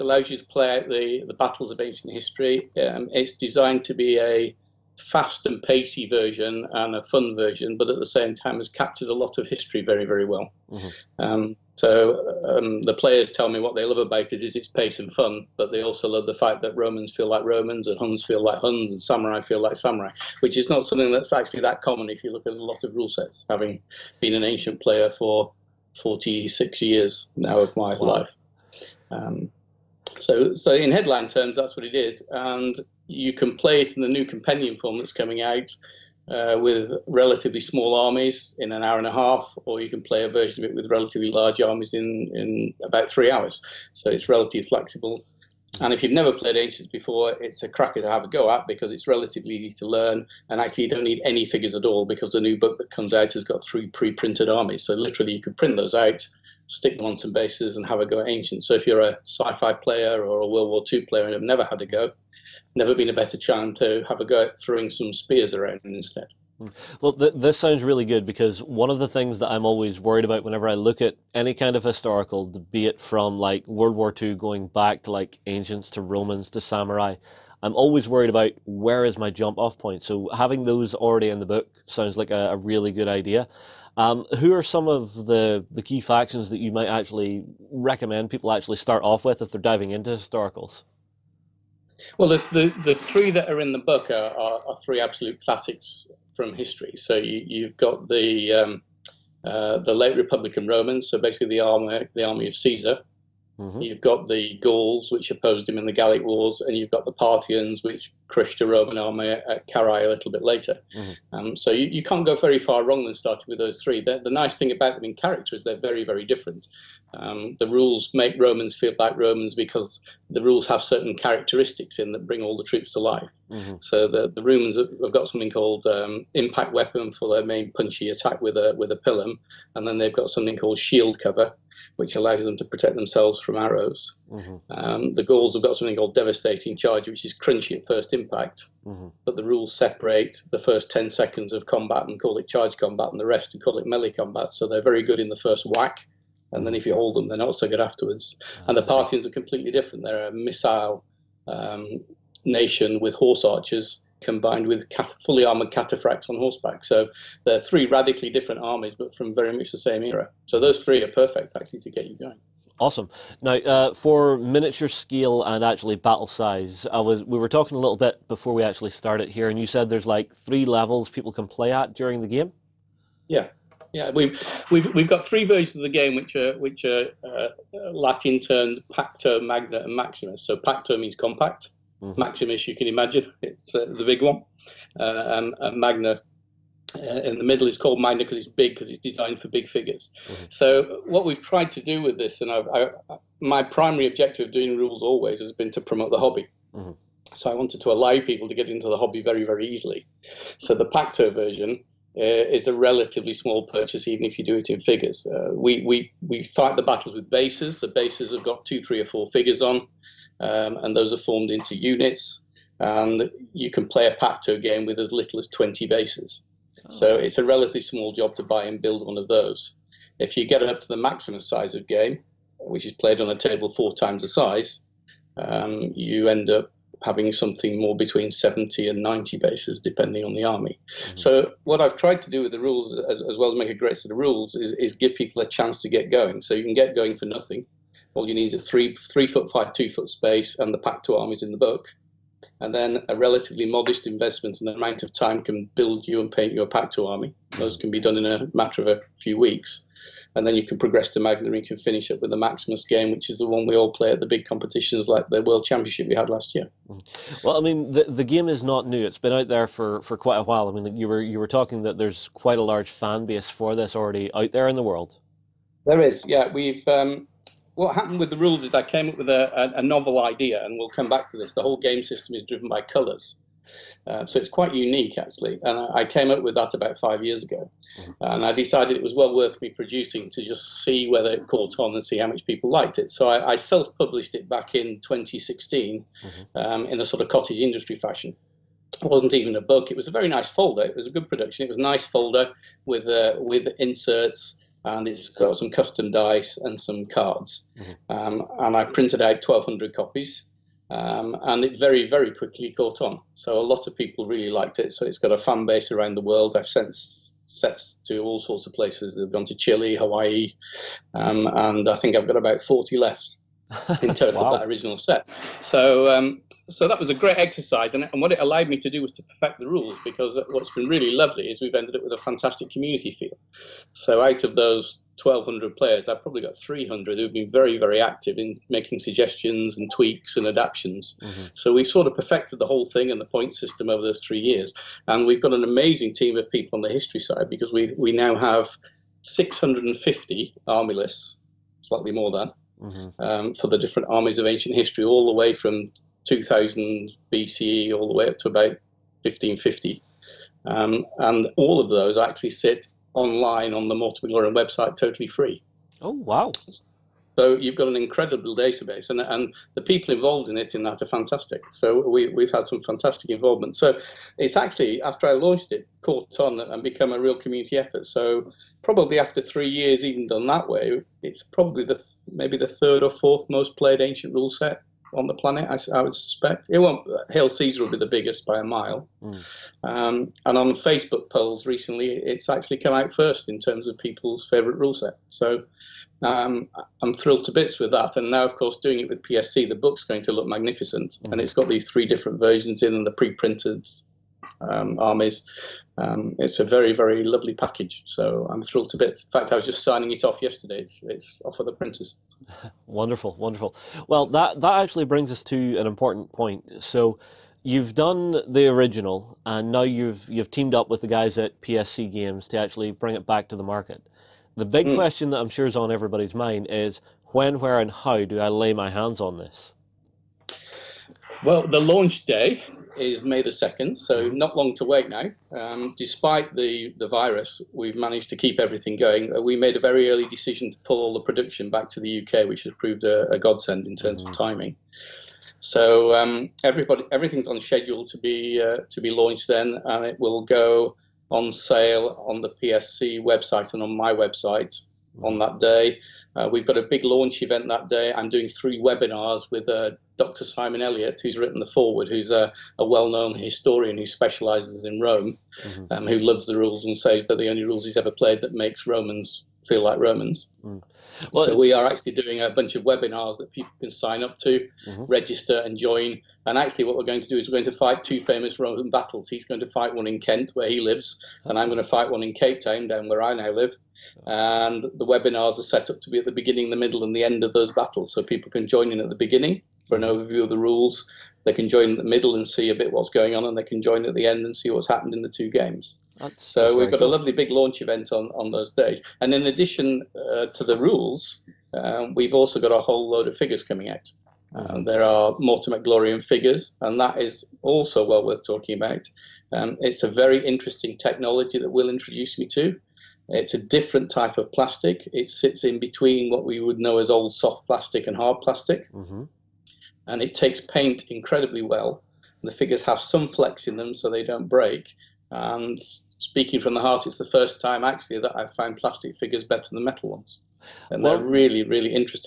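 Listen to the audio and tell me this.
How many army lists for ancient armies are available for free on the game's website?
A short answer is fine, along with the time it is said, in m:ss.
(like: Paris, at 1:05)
650, at 5:39.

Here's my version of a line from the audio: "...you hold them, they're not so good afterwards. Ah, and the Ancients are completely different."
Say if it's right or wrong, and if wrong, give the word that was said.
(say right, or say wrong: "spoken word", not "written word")
wrong: "Parthians", not "Ancients".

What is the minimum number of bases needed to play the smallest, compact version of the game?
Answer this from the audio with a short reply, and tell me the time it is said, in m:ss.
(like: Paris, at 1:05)
20, at 3:35.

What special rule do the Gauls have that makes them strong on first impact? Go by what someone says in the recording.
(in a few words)
Devastating charge.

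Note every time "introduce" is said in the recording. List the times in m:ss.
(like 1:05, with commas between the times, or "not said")
8:21.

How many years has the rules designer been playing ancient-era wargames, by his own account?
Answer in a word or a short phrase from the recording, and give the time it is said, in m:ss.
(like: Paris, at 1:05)
46, at 0:25.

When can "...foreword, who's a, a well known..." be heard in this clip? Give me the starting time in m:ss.
7:31.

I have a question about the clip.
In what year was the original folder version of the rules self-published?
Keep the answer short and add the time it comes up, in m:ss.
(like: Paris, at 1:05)
2016, at 4:44.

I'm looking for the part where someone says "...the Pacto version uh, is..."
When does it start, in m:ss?
3:20.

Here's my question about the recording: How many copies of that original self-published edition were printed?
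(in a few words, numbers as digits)
1,200.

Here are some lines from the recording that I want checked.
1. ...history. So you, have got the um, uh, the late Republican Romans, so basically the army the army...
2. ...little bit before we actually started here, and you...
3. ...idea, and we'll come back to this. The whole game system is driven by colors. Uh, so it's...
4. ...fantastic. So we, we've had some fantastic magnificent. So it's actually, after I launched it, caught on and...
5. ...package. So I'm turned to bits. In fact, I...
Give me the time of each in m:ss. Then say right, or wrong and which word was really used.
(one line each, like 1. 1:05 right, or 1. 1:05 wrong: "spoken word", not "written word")
1. 1:36 right
2. 2:47 right
3. 4:30 right
4. 6:01 wrong: "involvement", not "magnificent"
5. 6:37 wrong: "thrilled", not "turned".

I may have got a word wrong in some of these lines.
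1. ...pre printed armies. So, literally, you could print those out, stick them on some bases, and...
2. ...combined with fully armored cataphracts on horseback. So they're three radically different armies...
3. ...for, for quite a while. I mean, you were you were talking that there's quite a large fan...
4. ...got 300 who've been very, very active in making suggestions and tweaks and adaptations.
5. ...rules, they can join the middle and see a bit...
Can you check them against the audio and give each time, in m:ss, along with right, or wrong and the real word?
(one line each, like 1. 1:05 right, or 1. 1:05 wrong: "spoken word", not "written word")
1. 0:53 right
2. 2:34 right
3. 4:19 right
4. 5:26 right
5. 8:00 right.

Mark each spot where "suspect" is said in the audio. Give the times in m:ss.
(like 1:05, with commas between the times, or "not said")
6:16.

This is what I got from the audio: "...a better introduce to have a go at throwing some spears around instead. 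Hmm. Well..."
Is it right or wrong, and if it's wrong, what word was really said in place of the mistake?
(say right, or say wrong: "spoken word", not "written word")
wrong: "chance", not "introduce".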